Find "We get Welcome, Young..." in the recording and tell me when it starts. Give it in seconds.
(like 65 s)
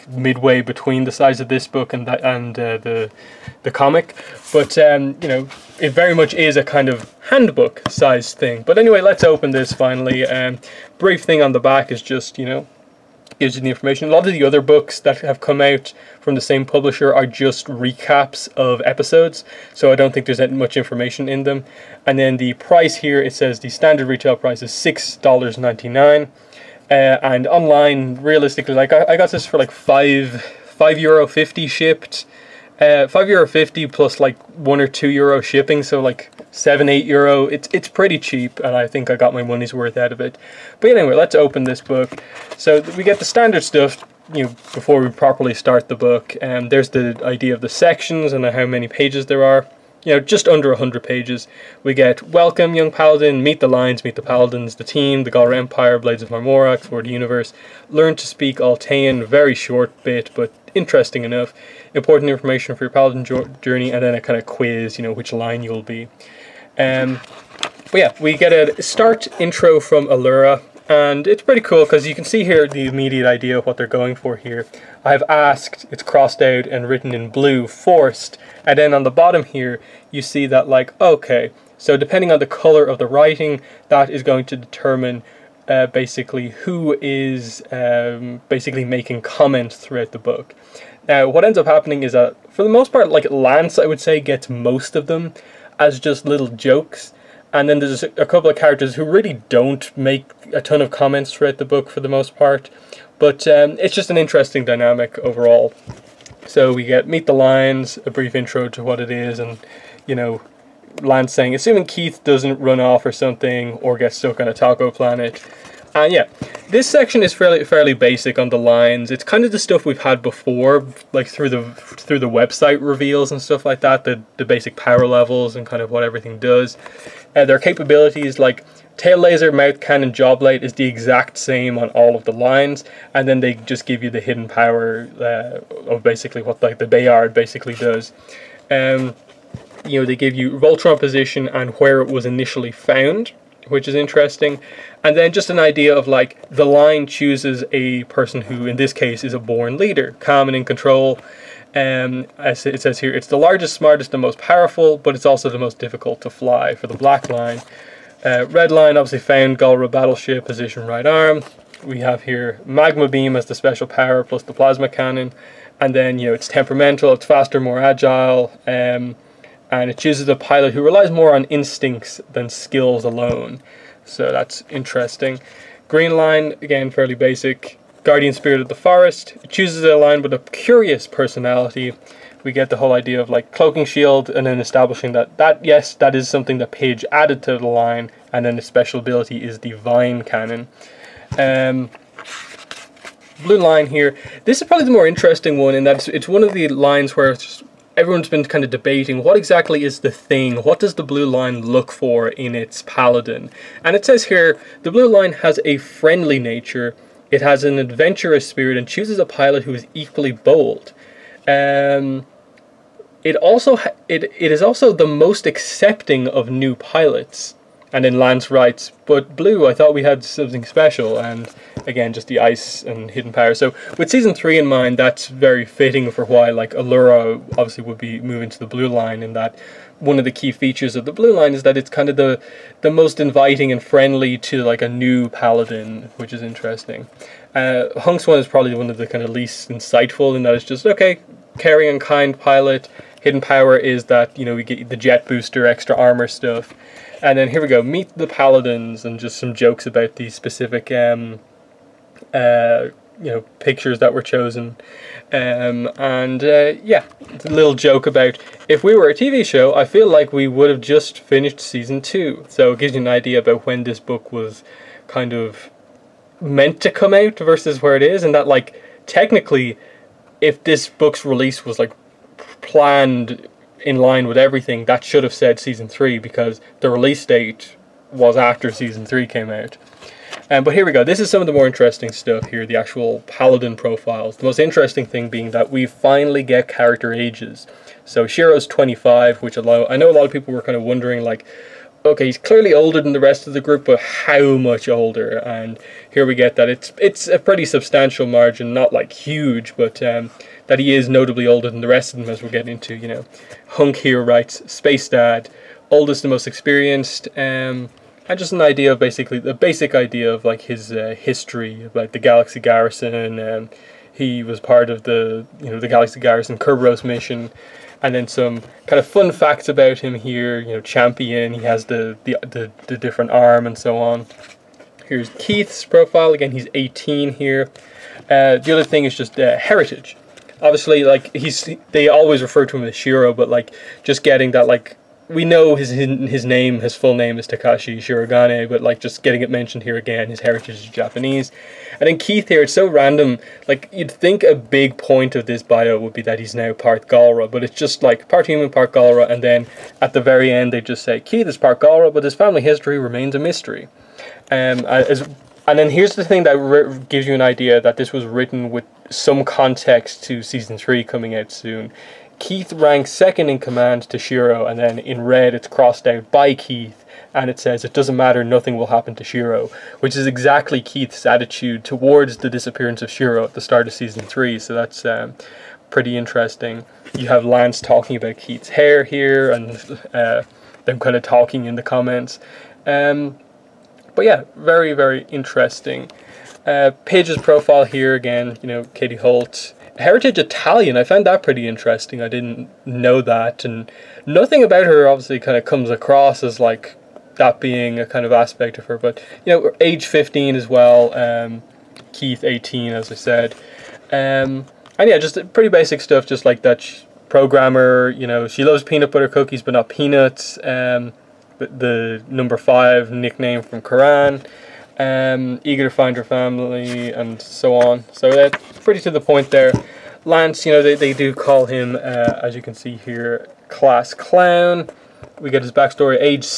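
51 s.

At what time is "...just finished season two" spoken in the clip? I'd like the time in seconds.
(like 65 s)
260 s.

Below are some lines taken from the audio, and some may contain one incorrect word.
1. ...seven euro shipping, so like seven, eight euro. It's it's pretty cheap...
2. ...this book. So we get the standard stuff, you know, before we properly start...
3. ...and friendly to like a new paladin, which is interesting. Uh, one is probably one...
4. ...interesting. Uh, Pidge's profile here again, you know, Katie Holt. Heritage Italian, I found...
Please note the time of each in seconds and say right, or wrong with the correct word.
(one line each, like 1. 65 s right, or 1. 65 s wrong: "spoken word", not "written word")
1. 34 s wrong: "two", not "seven"
2. 41 s right
3. 233 s right
4. 385 s right.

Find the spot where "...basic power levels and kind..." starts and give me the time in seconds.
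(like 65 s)
124 s.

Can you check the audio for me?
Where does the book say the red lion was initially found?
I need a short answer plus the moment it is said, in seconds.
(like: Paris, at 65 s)
Galra battleship, at 159 s.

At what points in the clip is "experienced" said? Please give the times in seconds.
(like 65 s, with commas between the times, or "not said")
306 s.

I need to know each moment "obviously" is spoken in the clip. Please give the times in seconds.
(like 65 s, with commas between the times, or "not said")
158 s, 227 s, 330 s, 395 s.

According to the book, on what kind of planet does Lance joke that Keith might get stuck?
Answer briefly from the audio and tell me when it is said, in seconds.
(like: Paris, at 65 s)
a taco planet, at 114 s.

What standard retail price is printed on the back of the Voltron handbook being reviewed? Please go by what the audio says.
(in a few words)
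$6.99.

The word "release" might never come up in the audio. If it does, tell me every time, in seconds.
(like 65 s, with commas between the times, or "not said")
271 s, 276 s.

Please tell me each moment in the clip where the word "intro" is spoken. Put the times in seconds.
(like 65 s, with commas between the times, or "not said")
69 s, 108 s.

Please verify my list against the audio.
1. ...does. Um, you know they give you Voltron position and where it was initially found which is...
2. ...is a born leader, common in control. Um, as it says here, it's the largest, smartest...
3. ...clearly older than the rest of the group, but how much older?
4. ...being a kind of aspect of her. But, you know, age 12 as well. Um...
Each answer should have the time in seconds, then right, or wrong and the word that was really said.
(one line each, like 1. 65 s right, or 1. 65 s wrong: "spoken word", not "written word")
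1. 137 s right
2. 149 s right
3. 292 s right
4. 397 s wrong: "15", not "12".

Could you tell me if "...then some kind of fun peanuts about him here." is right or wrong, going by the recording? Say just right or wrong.
wrong.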